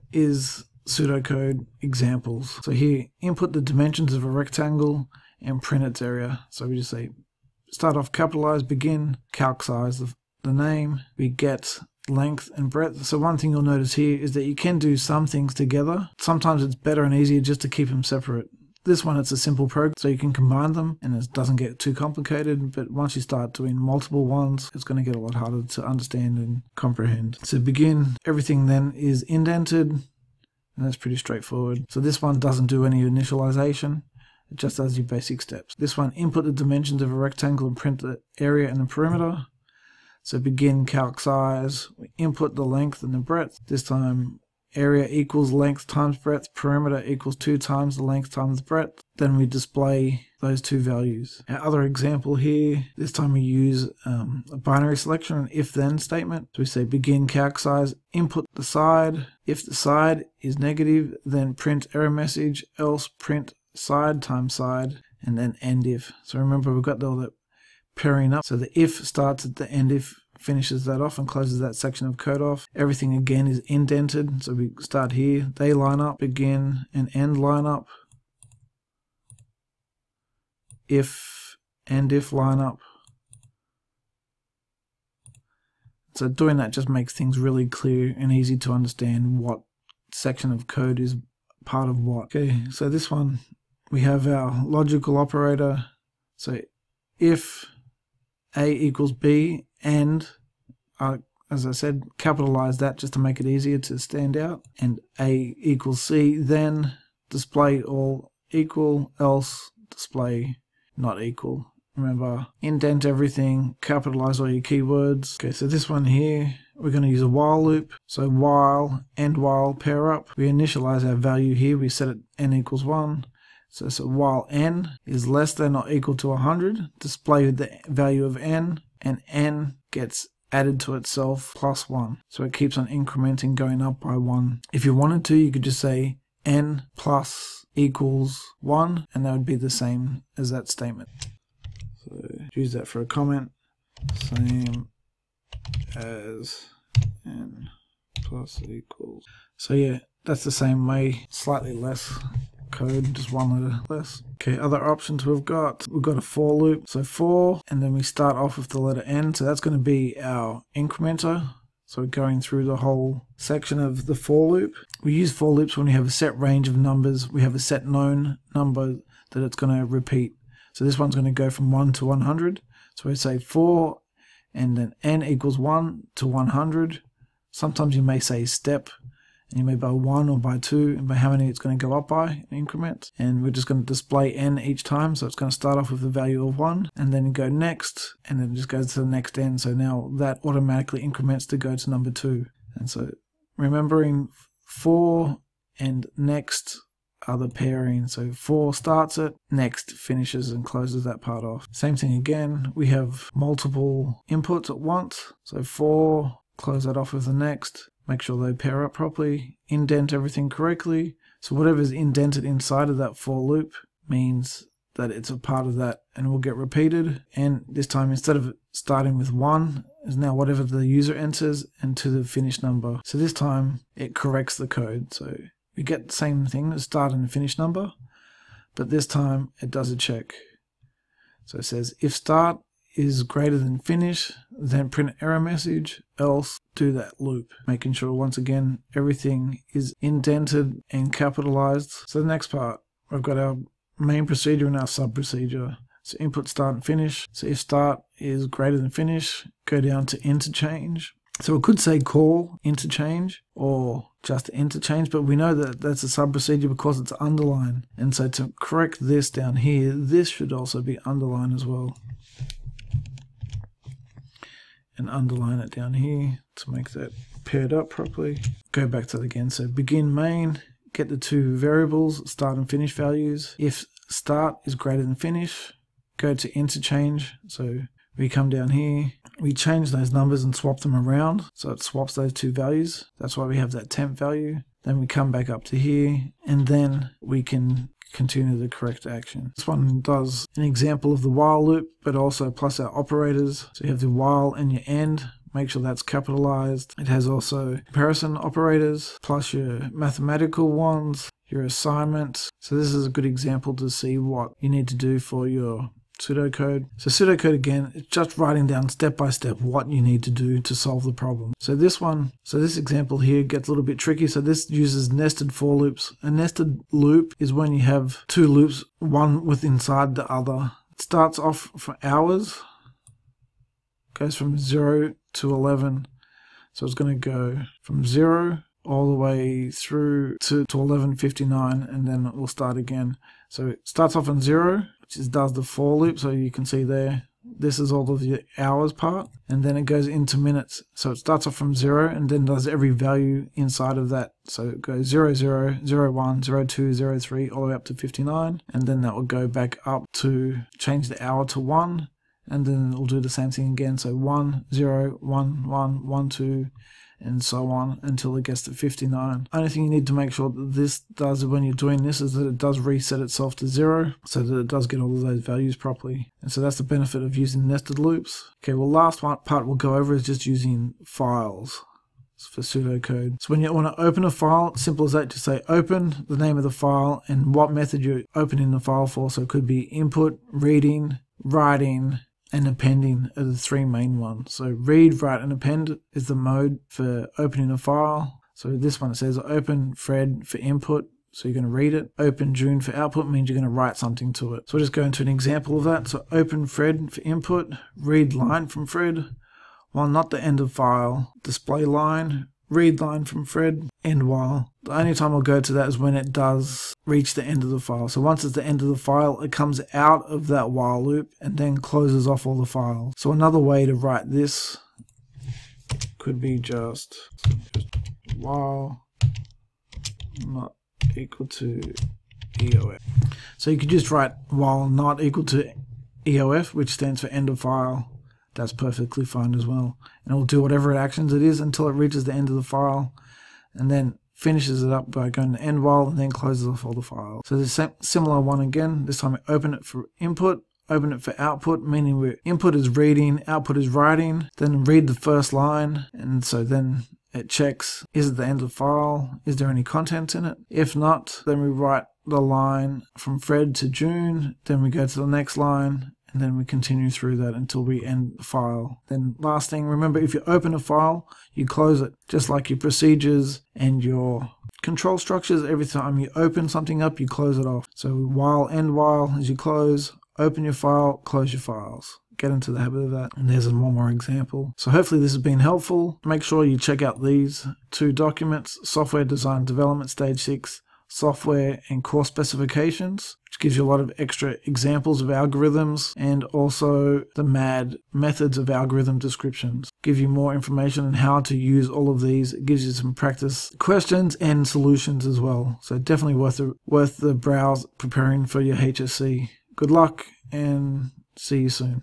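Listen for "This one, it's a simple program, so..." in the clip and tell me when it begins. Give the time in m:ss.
0:18.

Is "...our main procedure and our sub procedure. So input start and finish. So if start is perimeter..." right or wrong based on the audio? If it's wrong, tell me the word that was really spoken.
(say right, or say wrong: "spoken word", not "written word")
wrong: "greater", not "perimeter".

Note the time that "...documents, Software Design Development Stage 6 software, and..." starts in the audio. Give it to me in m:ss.
7:58.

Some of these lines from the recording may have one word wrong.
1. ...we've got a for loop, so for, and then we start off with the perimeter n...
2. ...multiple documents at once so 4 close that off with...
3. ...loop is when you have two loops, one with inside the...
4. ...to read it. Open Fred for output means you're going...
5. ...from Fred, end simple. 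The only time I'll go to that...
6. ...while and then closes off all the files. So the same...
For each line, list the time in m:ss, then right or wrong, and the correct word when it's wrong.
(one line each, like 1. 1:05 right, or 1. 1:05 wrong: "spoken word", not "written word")
1. 2:35 wrong: "letter", not "perimeter"
2. 3:23 wrong: "inputs", not "documents"
3. 5:16 right
4. 6:31 wrong: "June", not "Fred"
5. 6:43 wrong: "while", not "simple"
6. 7:15 right.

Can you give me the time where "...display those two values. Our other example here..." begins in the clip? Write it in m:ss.
0:49.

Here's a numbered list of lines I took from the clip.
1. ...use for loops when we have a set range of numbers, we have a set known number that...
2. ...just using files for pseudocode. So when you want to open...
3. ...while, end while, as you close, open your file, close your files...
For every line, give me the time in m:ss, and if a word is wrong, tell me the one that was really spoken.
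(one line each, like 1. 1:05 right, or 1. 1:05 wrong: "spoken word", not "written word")
1. 2:45 right
2. 6:10 right
3. 7:48 right.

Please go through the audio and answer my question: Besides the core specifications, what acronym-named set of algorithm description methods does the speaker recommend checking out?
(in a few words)
MAD.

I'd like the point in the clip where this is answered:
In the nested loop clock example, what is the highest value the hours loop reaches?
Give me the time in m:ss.
5:25.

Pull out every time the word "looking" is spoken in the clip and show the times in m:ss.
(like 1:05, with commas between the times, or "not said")
not said.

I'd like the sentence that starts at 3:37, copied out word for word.
And this time, instead of starting with one, is now whatever the user enters and to the finish number.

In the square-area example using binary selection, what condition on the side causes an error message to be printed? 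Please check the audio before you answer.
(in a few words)
negative.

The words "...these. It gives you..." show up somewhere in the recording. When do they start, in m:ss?
8:12.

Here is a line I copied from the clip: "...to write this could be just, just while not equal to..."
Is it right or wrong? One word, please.
right.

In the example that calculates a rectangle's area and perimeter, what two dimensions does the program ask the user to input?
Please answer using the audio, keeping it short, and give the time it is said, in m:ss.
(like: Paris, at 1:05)
length and breadth, at 0:42.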